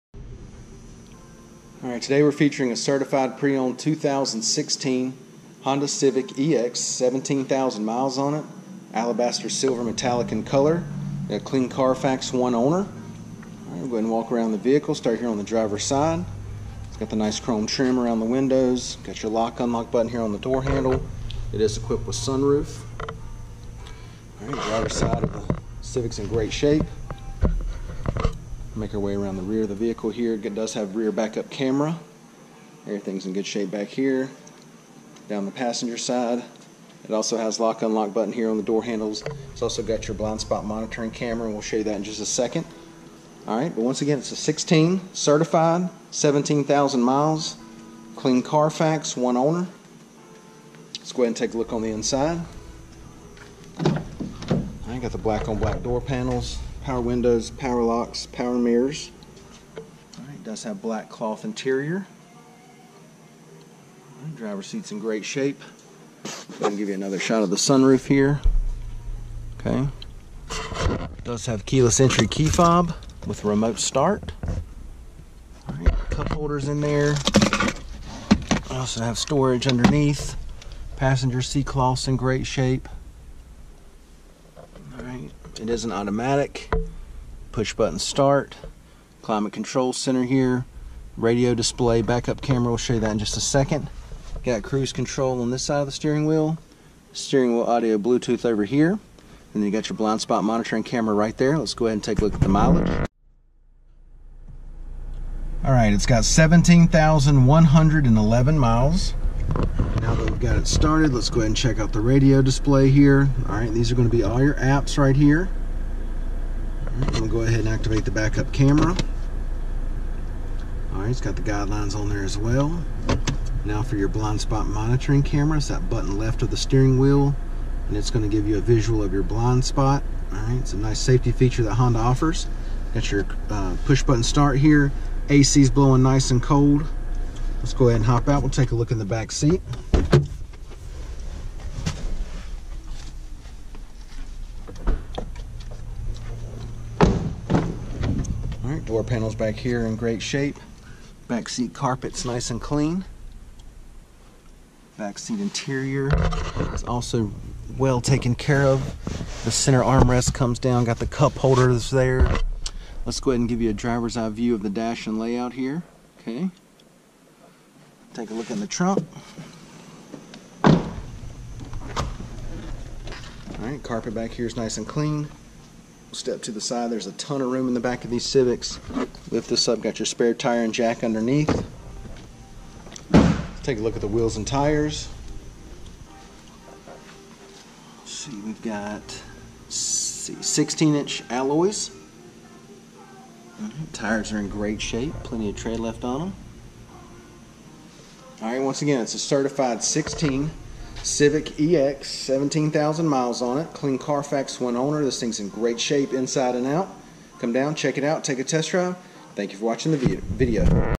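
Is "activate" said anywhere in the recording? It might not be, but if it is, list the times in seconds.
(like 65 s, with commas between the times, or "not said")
117 s.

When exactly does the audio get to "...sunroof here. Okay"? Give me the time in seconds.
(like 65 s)
67 s.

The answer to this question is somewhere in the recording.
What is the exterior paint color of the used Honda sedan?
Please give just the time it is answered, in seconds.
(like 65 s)
8 s.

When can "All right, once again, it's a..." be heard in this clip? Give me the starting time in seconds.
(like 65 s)
198 s.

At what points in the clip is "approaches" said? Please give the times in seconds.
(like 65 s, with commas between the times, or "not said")
not said.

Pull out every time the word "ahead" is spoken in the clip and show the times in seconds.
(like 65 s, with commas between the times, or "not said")
13 s, 51 s, 101 s, 111 s, 117 s, 137 s, 163 s.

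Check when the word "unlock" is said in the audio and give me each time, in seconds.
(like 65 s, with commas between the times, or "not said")
19 s, 37 s.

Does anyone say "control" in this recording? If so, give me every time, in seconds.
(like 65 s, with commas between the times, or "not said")
89 s, 94 s.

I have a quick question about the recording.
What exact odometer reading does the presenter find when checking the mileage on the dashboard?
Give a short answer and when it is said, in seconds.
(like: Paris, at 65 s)
17,111, at 106 s.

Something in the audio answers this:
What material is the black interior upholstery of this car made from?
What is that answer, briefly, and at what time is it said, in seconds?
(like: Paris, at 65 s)
cloth, at 60 s.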